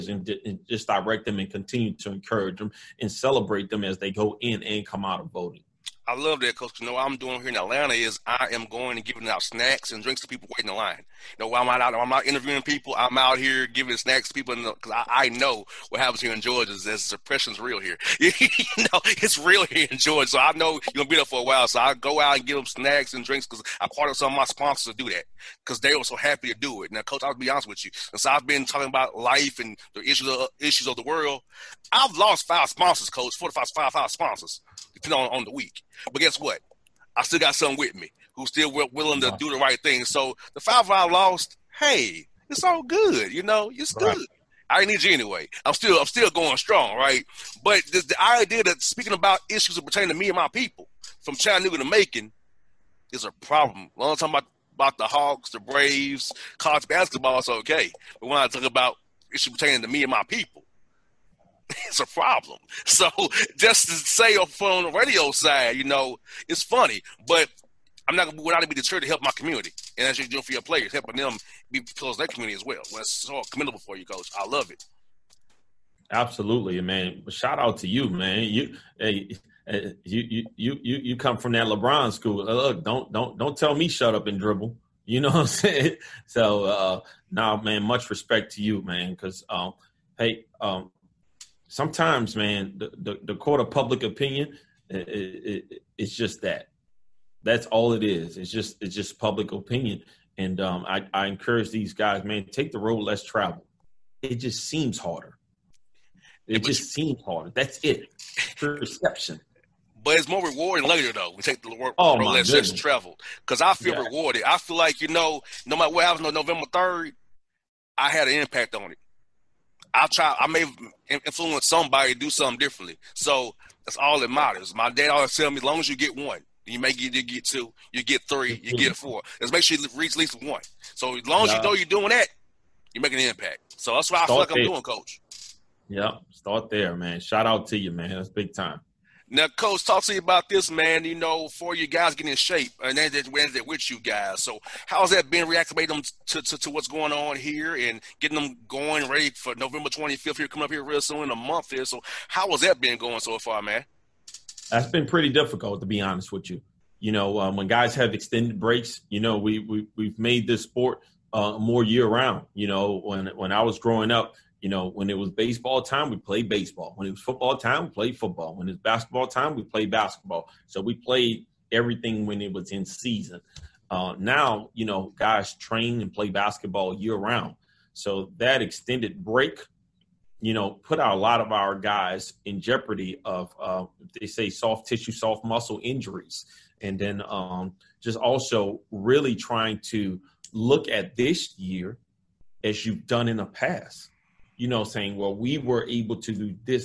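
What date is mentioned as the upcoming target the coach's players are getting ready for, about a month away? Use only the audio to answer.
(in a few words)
November 25th.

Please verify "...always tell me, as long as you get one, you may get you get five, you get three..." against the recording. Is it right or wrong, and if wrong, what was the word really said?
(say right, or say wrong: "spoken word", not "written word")
wrong: "two", not "five".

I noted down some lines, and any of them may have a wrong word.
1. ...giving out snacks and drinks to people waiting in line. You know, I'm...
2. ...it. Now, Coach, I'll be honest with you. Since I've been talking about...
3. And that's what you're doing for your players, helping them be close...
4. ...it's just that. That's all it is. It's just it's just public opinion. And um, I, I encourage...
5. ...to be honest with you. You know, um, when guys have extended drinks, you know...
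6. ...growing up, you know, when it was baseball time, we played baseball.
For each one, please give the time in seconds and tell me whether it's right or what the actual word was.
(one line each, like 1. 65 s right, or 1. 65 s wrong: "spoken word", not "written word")
1. 9 s right
2. 26 s right
3. 69 s right
4. 95 s right
5. 155 s wrong: "breaks", not "drinks"
6. 163 s right.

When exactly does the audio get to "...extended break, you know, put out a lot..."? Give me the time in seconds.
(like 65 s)
178 s.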